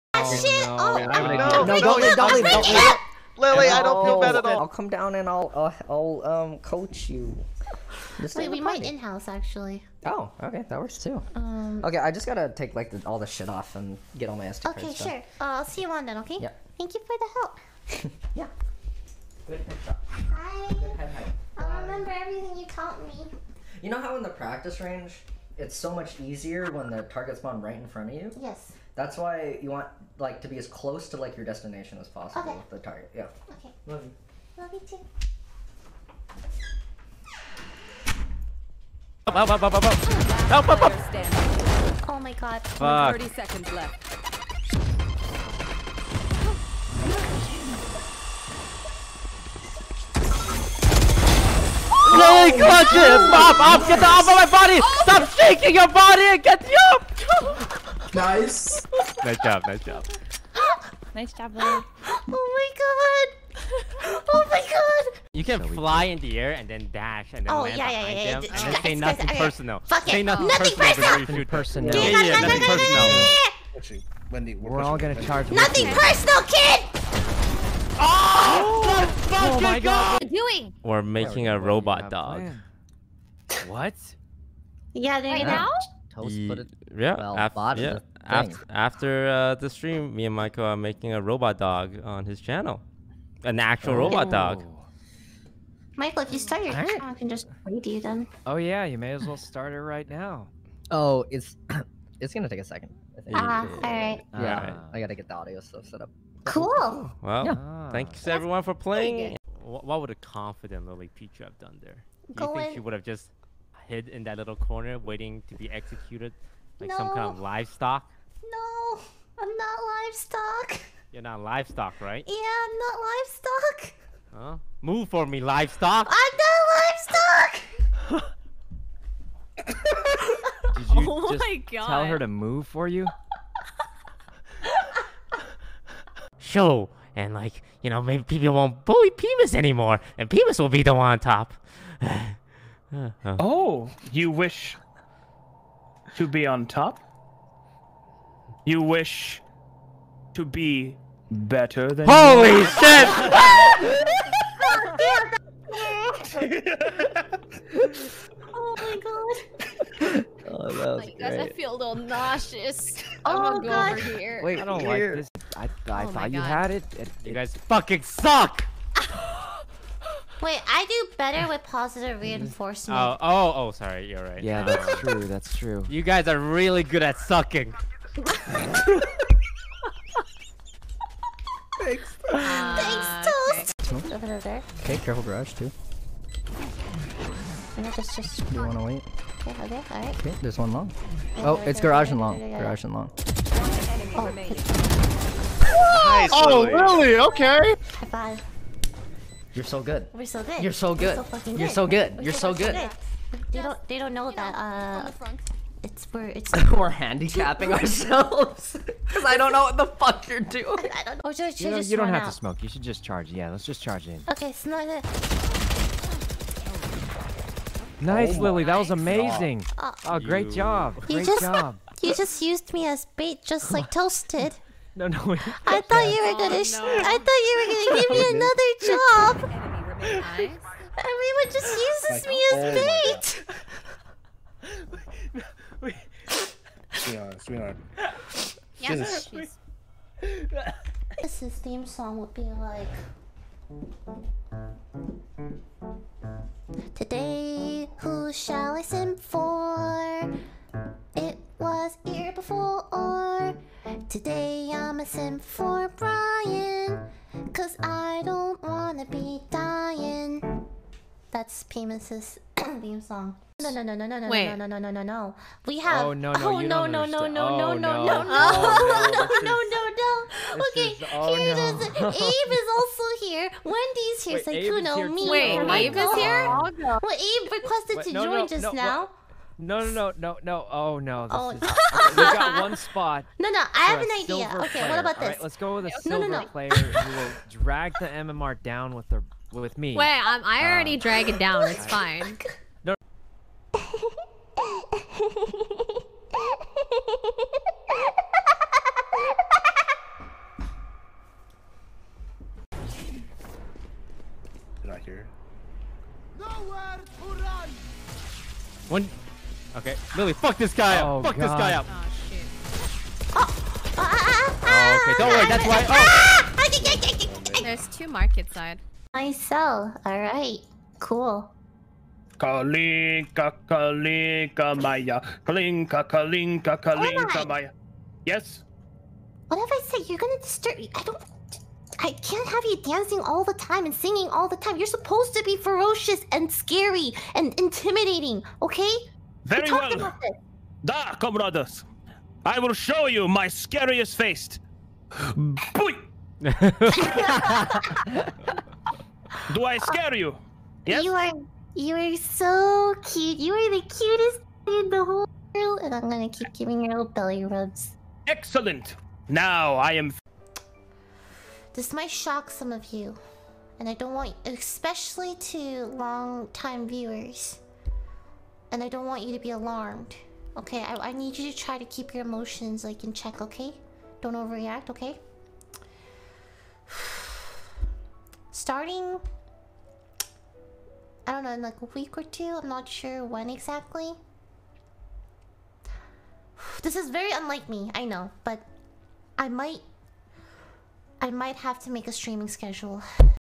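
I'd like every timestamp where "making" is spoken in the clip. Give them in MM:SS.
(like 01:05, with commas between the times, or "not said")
01:21, 01:30.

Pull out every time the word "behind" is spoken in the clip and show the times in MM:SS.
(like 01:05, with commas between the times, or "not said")
01:07.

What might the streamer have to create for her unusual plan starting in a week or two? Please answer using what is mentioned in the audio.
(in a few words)
streaming schedule.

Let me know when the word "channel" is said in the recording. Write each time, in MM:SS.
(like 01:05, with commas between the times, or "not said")
01:32, 01:36.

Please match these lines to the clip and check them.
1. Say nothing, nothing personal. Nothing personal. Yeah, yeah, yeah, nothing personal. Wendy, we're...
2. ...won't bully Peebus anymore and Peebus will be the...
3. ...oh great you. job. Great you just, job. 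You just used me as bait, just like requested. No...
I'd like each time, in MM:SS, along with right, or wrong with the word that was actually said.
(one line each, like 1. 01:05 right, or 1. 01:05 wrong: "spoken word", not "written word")
1. 01:10 right
2. 02:18 right
3. 03:40 wrong: "toasted", not "requested".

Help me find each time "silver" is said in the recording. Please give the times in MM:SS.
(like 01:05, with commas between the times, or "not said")
04:46.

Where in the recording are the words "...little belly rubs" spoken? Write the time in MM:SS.
05:56.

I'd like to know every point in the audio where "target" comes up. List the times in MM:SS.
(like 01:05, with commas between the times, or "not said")
00:27, 00:32.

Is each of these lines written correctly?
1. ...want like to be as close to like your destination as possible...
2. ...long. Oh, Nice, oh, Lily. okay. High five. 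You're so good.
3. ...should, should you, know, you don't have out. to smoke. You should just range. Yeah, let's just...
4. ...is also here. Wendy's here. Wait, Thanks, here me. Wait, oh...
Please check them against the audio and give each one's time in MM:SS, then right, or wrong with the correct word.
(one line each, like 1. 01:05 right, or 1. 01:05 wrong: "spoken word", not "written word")
1. 00:29 right
2. 03:12 right
3. 03:31 wrong: "charge", not "range"
4. 04:32 wrong: "Sykkuno", not "Thanks".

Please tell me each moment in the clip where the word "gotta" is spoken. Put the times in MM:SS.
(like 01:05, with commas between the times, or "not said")
00:12, 01:44.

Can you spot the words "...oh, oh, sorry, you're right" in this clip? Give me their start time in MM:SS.
02:53.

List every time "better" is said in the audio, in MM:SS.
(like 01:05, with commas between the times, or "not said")
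02:31, 02:51.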